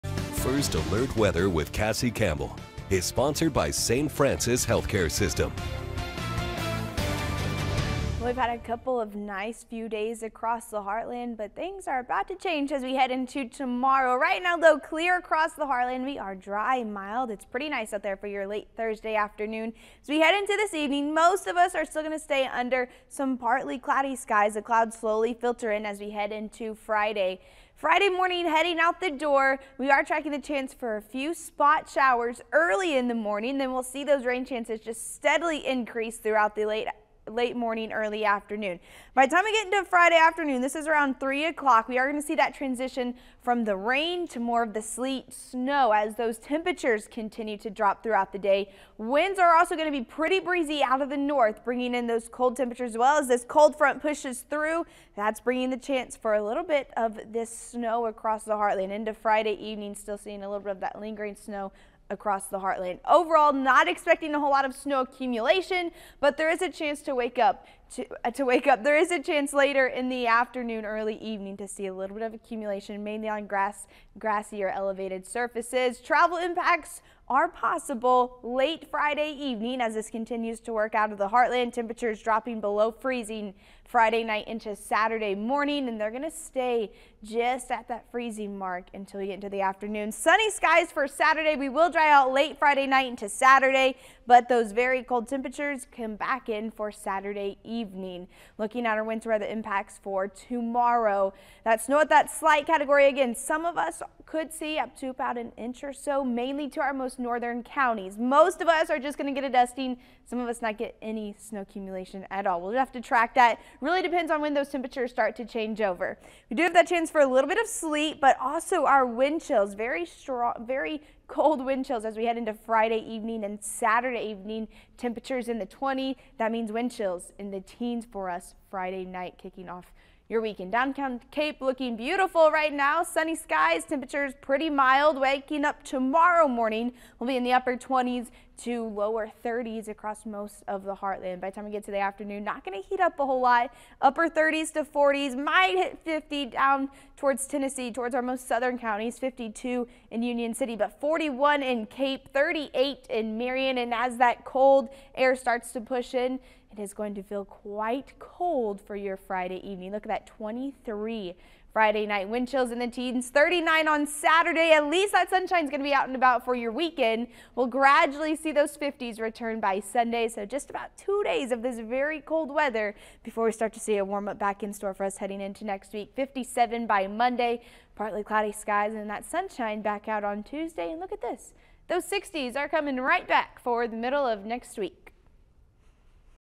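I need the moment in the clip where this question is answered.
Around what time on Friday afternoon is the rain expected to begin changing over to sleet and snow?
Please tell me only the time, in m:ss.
0:41.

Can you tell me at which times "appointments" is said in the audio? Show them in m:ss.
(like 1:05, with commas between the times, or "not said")
not said.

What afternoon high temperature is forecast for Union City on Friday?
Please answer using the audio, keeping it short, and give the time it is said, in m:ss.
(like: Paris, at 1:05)
52, at 2:29.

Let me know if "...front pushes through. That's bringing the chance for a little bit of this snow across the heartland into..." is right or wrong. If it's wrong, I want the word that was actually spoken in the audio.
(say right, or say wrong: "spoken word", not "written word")
right.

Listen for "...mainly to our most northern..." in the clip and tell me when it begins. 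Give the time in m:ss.
1:46.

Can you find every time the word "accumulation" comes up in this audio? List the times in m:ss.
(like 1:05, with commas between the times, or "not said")
1:04, 1:12, 1:51.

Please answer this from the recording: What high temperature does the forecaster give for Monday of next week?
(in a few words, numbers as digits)
57.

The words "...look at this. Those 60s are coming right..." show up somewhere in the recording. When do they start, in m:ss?
3:01.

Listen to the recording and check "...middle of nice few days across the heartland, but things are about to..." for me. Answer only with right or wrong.
wrong.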